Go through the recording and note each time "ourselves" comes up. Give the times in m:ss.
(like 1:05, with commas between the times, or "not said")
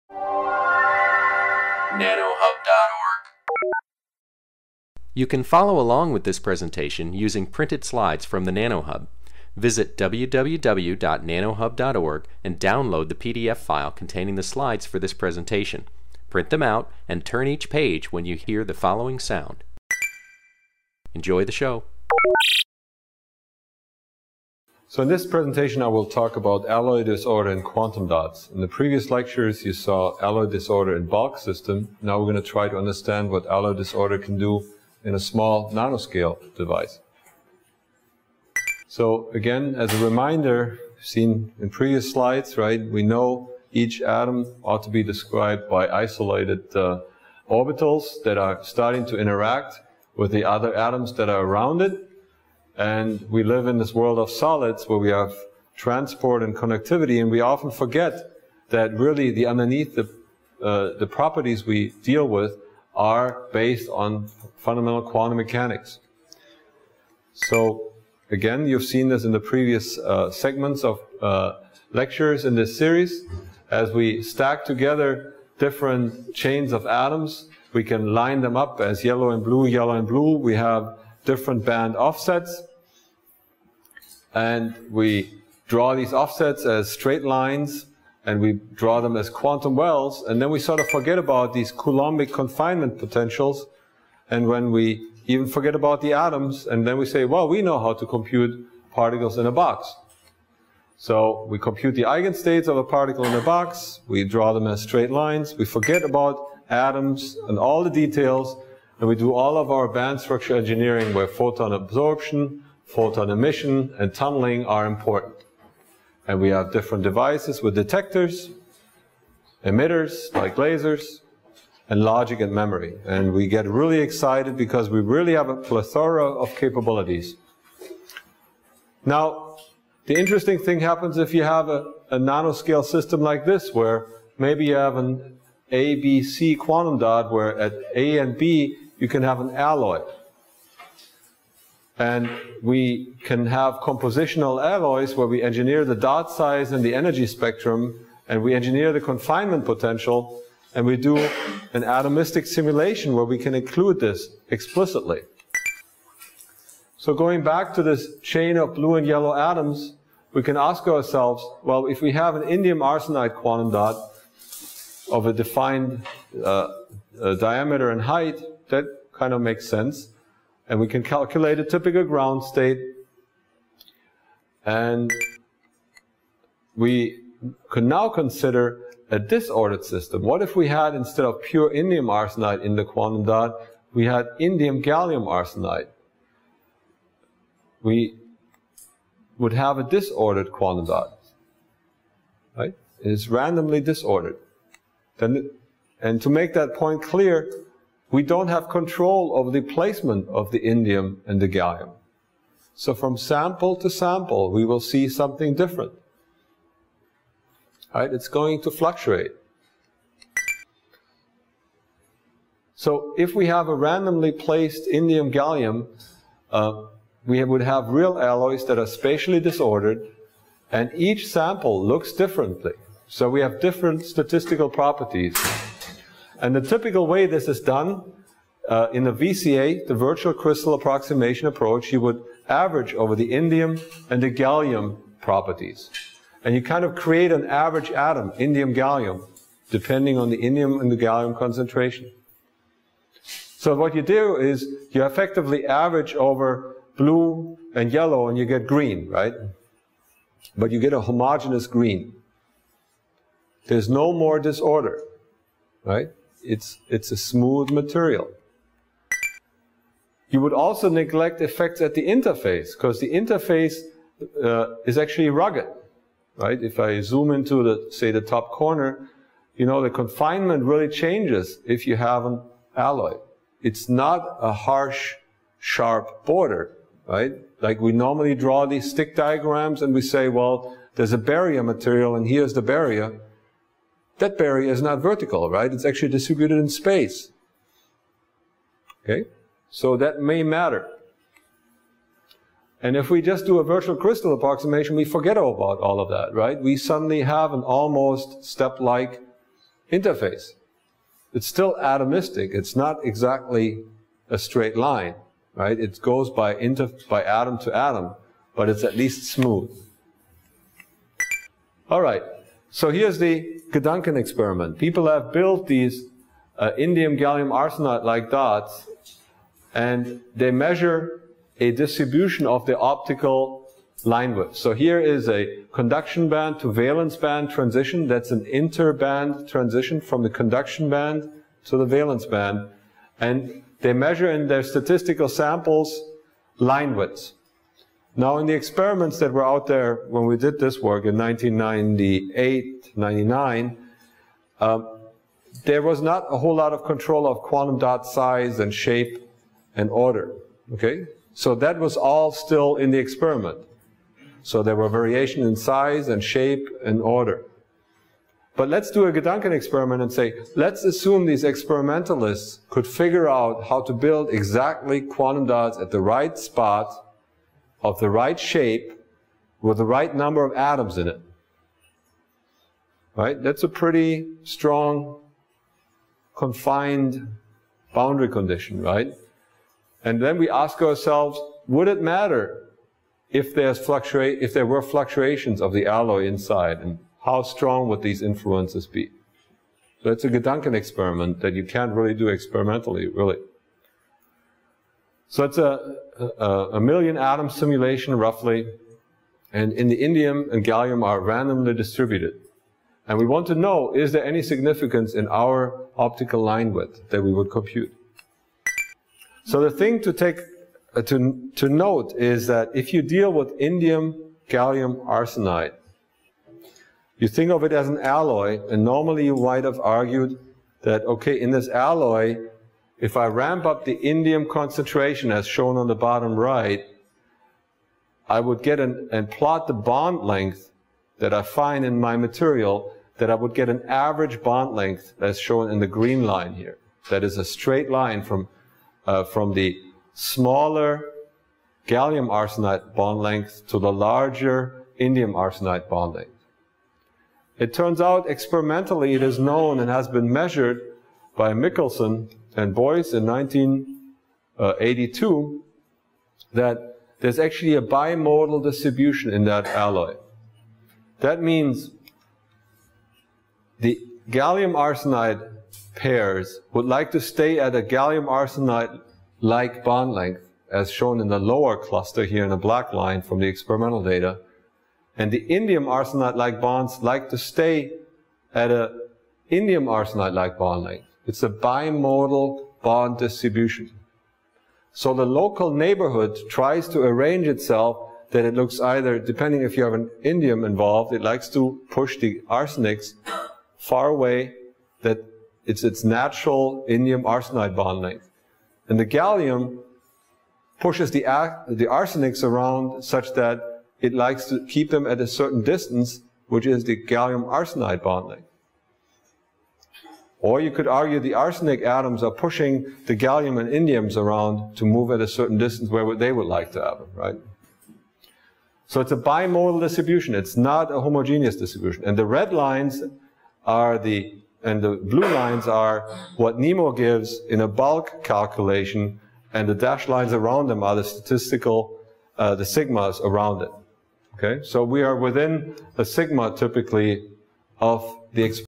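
2:40, 6:20.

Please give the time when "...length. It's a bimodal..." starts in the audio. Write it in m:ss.
8:00.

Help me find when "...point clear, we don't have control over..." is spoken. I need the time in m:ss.
3:16.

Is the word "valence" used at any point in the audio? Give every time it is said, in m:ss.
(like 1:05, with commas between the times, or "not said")
5:26, 5:31.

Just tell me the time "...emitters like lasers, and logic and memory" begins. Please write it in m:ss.
1:59.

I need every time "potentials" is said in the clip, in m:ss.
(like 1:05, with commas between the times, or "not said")
1:32, 2:29.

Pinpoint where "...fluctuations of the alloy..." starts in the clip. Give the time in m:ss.
6:24.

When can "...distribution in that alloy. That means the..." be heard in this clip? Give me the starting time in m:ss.
7:38.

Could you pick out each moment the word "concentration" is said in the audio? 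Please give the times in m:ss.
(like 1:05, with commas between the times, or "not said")
4:01, 7:04.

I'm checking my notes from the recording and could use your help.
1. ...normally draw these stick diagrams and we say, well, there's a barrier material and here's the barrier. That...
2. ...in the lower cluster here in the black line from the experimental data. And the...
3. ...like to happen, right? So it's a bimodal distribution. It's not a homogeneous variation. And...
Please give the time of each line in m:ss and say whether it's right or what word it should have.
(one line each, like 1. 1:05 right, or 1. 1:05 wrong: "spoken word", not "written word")
1. 4:37 right
2. 7:51 right
3. 8:36 wrong: "distribution", not "variation".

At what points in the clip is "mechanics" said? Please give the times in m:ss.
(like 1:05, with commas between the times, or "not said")
1:05.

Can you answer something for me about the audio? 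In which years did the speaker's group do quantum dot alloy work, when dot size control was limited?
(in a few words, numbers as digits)
1998-1999.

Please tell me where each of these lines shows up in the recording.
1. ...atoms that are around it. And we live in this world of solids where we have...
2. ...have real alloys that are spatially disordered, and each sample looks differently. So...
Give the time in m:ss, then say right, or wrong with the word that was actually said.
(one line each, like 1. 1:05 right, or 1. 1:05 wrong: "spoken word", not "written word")
1. 0:50 right
2. 3:37 right.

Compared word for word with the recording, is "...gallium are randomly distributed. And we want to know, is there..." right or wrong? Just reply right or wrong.
right.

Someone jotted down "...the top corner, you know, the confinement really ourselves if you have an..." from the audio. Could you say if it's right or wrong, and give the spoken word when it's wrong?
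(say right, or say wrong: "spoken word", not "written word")
wrong: "changes", not "ourselves".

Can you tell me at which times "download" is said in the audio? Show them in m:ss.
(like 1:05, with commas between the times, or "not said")
0:12.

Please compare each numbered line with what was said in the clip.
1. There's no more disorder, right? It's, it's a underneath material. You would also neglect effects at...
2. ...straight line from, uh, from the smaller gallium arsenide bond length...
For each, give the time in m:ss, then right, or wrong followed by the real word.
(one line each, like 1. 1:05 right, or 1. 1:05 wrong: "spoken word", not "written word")
1. 4:13 wrong: "smooth", not "underneath"
2. 7:17 right.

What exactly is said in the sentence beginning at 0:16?
Print them out and turn each page when you hear the following sound.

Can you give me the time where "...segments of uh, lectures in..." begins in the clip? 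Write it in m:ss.
1:10.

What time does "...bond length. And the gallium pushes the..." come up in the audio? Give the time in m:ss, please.
8:17.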